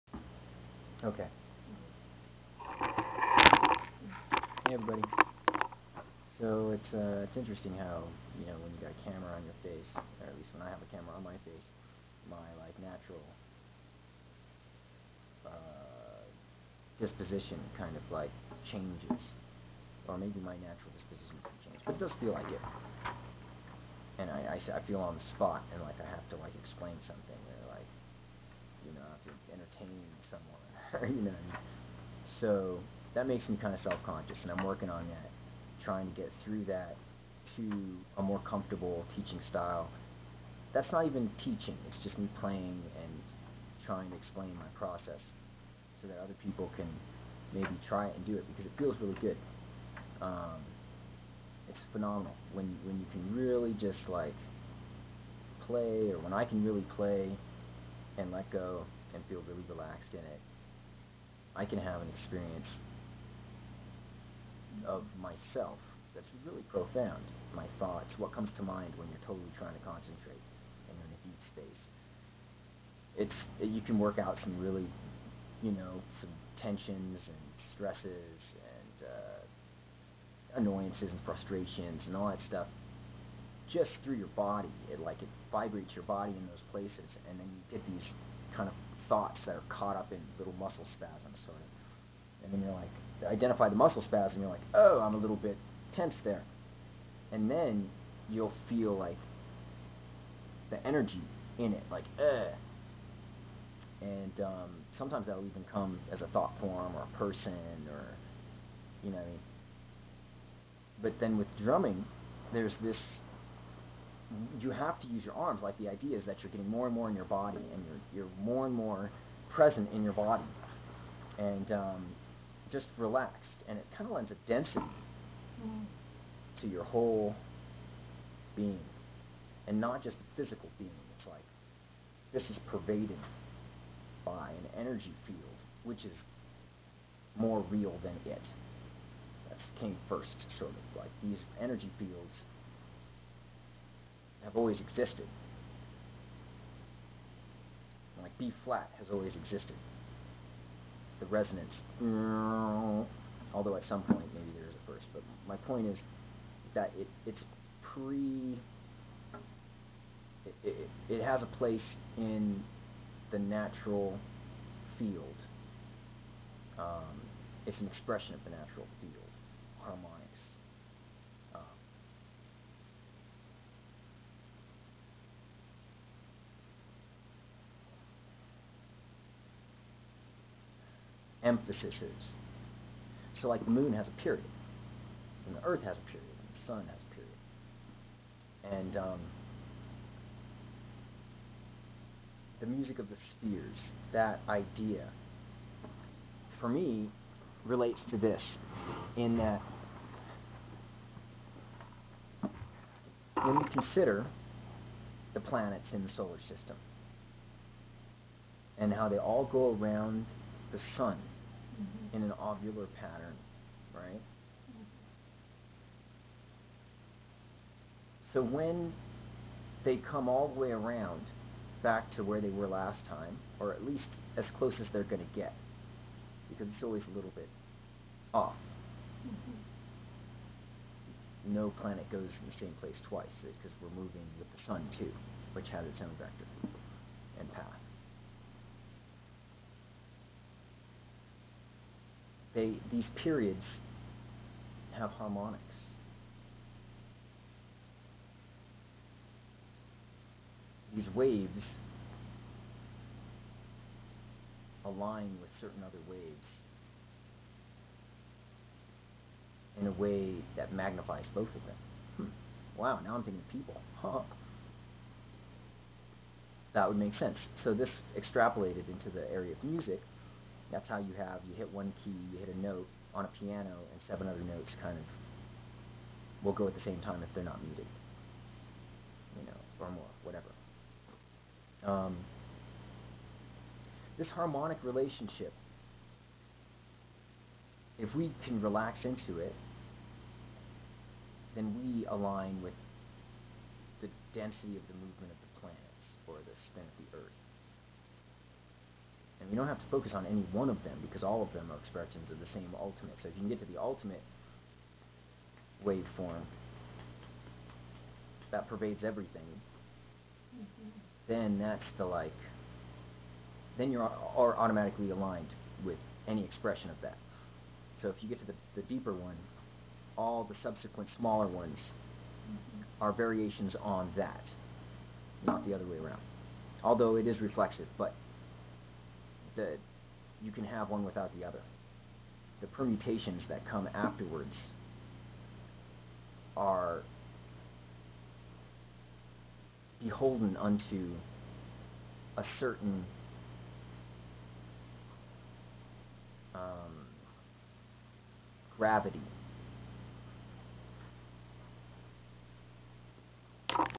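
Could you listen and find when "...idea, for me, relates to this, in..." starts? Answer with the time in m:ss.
3:14.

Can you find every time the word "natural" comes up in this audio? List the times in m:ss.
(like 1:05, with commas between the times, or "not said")
0:12, 0:20, 2:43, 2:48.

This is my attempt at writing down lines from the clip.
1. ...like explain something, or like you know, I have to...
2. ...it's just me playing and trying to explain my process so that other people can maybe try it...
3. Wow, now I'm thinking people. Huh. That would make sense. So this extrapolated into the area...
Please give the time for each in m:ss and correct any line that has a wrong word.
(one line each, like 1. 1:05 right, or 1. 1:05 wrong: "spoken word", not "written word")
1. 0:26 right
2. 0:41 right
3. 4:22 right.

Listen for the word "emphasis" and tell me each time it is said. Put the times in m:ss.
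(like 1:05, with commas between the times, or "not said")
3:01.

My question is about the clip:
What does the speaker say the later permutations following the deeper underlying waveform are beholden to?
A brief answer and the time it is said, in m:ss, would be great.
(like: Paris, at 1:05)
gravity, at 5:48.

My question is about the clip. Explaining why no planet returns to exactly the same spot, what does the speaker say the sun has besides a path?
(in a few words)
vector.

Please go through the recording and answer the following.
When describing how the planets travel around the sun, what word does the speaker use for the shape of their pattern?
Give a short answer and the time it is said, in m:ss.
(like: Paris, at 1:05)
ovular, at 3:32.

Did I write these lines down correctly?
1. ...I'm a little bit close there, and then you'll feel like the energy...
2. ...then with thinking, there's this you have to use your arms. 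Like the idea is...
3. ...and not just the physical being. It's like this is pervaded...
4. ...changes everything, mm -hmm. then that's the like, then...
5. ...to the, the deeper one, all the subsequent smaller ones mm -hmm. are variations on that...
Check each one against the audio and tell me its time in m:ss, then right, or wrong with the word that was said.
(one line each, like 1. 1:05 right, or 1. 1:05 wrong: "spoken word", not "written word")
1. 1:34 wrong: "tense", not "close"
2. 1:51 wrong: "drumming", not "thinking"
3. 2:09 right
4. 5:08 wrong: "pervades", not "changes"
5. 5:18 right.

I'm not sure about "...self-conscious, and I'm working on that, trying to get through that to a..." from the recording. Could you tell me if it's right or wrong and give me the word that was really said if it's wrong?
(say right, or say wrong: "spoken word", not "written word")
right.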